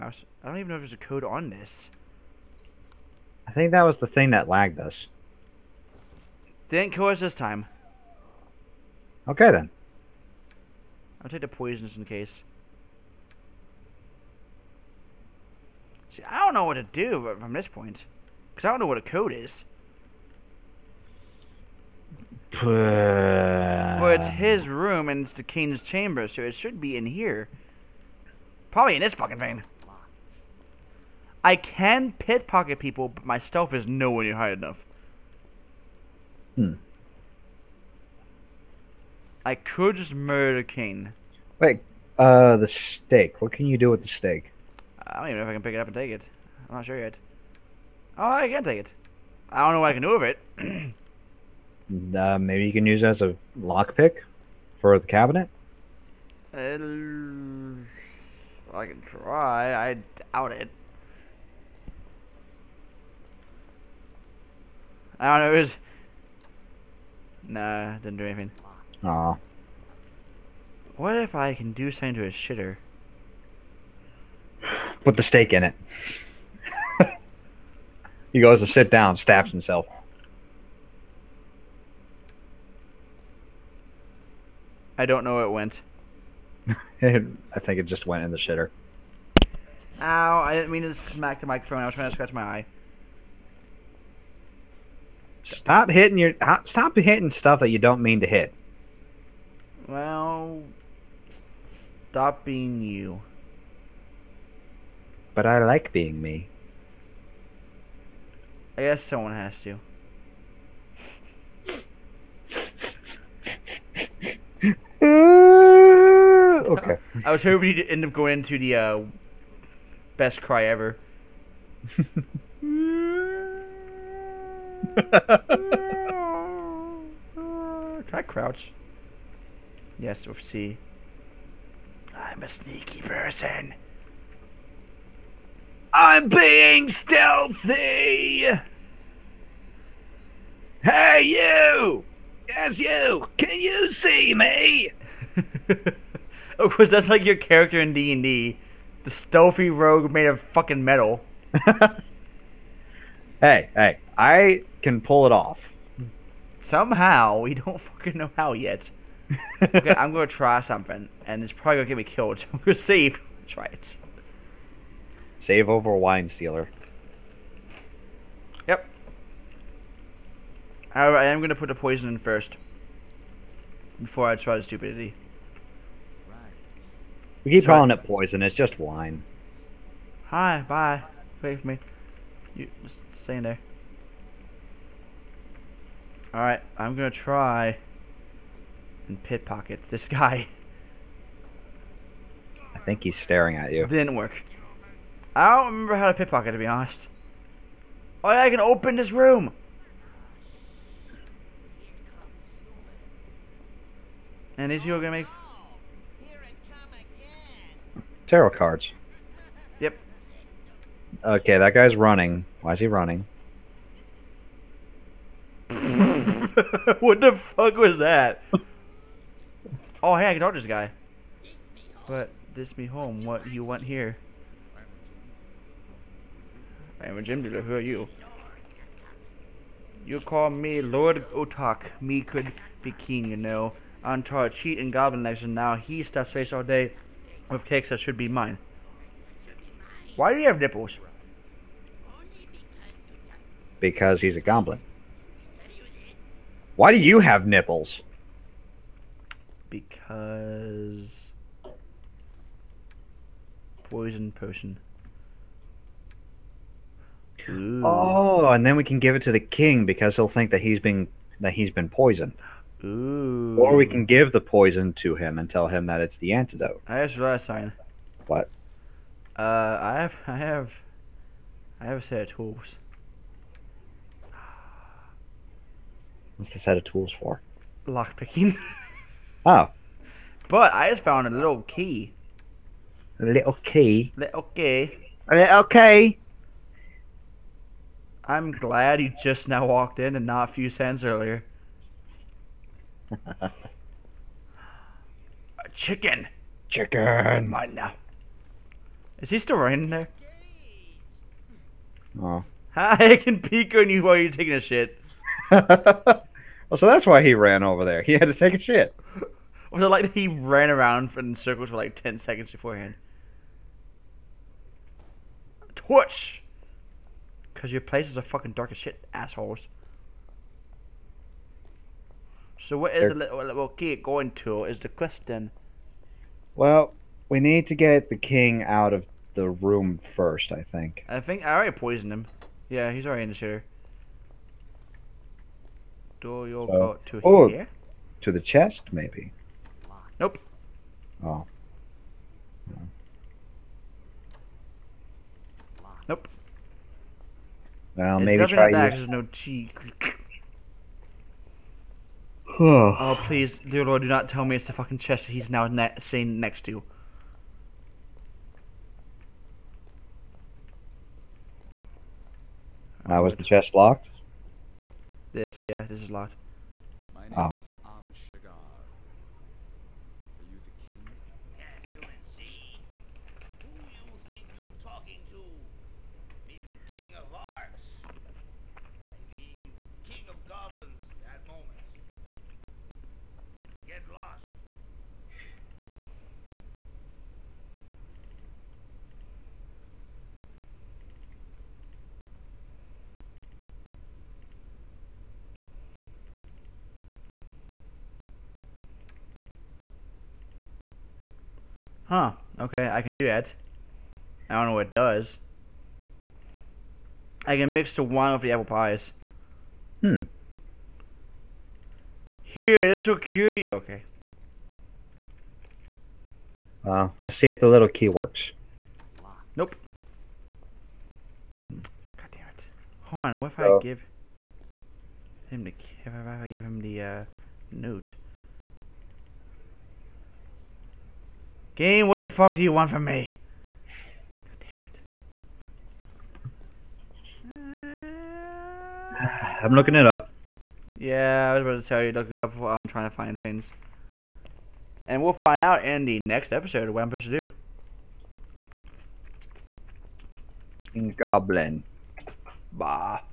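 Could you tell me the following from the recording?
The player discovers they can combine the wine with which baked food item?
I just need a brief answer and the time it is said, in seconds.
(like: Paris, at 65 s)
Apple pies, at 408 s.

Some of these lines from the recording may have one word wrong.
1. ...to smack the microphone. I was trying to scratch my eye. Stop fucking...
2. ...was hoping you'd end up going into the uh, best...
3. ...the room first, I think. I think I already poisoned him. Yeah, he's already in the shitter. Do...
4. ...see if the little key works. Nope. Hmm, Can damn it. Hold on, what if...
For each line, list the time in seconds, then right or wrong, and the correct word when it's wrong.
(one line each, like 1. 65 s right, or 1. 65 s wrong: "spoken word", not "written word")
1. 90 s wrong: "hitting", not "fucking"
2. 117 s right
3. 329 s right
4. 417 s wrong: "God", not "Can".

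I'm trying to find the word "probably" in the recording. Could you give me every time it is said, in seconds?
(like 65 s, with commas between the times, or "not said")
28 s, 161 s.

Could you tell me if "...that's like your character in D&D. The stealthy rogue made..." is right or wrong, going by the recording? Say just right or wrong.
right.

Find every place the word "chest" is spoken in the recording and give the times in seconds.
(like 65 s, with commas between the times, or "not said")
338 s, 354 s, 363 s.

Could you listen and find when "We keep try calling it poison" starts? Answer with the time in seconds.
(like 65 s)
177 s.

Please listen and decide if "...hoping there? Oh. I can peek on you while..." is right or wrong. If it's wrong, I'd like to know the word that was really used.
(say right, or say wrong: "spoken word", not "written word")
wrong: "running", not "hoping".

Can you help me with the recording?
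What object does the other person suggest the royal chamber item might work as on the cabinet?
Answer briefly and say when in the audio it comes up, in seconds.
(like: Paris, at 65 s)
A lockpick, at 53 s.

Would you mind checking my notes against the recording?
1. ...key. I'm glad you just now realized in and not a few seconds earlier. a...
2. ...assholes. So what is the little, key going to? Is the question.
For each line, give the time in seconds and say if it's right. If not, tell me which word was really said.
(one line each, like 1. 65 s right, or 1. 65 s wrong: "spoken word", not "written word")
1. 285 s wrong: "walked", not "realized"
2. 319 s right.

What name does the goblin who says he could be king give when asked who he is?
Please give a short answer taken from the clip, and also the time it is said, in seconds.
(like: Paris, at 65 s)
Lord Otak, at 230 s.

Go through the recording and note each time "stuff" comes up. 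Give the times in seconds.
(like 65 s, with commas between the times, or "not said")
97 s, 236 s.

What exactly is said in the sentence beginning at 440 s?
Yeah, I was about to tell you, look it up while I'm trying to find things.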